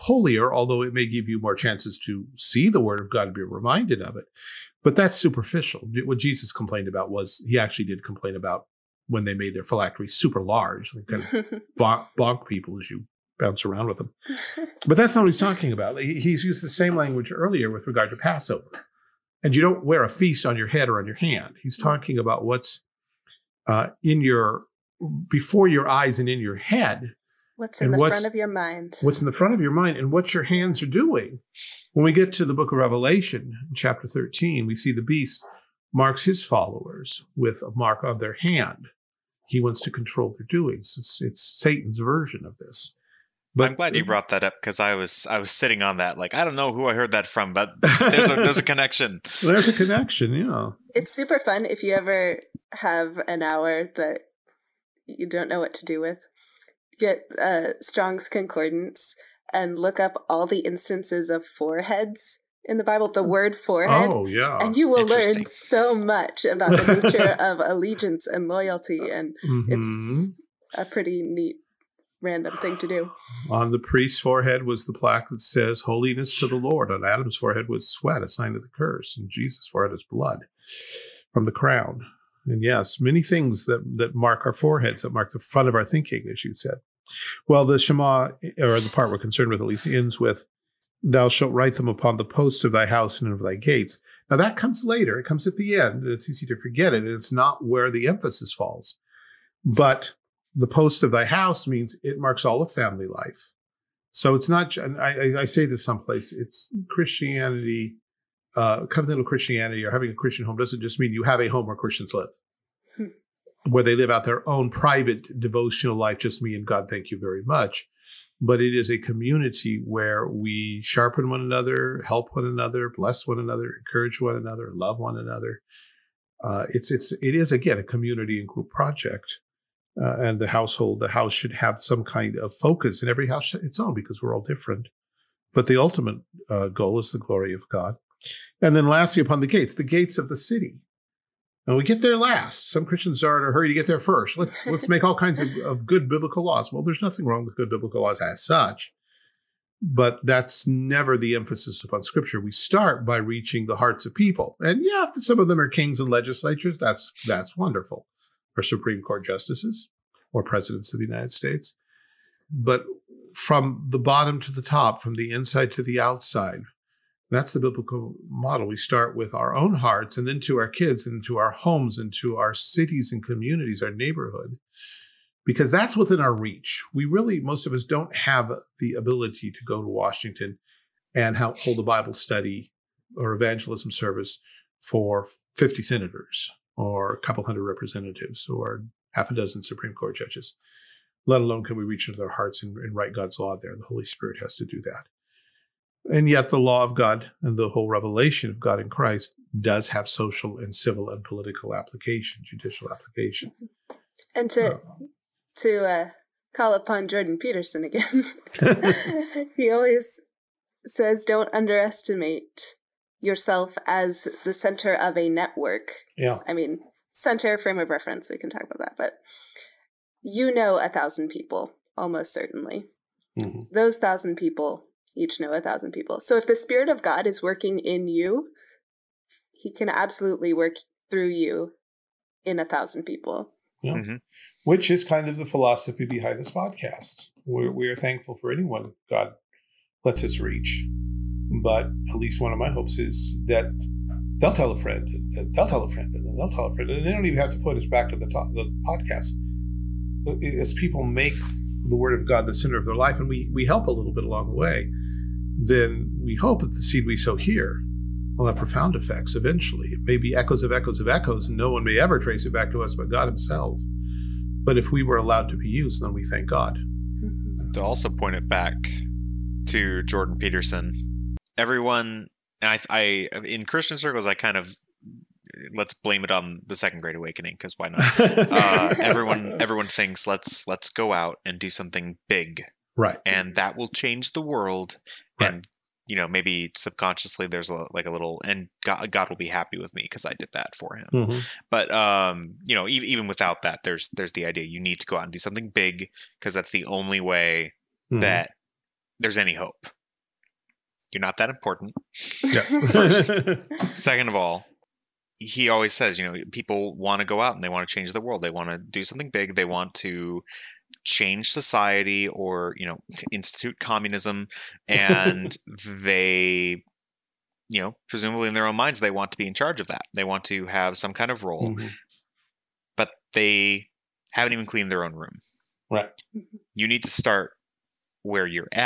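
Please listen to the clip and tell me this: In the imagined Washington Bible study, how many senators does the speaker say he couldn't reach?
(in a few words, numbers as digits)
50.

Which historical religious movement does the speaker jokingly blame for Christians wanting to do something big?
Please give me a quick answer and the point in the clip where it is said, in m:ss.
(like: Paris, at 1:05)
The Second Great Awakening, at 4:36.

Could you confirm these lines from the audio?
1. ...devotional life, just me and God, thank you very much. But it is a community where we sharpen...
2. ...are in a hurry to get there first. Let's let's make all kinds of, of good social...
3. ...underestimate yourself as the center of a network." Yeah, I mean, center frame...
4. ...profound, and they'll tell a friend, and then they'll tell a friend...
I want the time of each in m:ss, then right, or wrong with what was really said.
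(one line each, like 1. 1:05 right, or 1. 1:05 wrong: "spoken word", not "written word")
1. 1:55 right
2. 2:23 wrong: "biblical", not "social"
3. 3:31 right
4. 4:04 wrong: "friend", not "profound".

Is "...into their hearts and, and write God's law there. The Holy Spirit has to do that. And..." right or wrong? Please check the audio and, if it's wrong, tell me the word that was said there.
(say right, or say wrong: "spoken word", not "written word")
right.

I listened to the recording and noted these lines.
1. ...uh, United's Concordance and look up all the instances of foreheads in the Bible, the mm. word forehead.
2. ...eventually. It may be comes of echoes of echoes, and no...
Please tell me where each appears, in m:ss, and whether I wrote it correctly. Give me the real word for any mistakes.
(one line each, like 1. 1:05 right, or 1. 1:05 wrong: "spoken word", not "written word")
1. 0:57 wrong: "Strong", not "United"
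2. 4:19 wrong: "echoes", not "comes".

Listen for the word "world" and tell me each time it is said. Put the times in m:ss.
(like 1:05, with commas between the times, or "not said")
4:44, 5:08.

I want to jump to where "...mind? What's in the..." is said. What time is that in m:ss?
0:28.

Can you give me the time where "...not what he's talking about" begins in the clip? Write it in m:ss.
0:15.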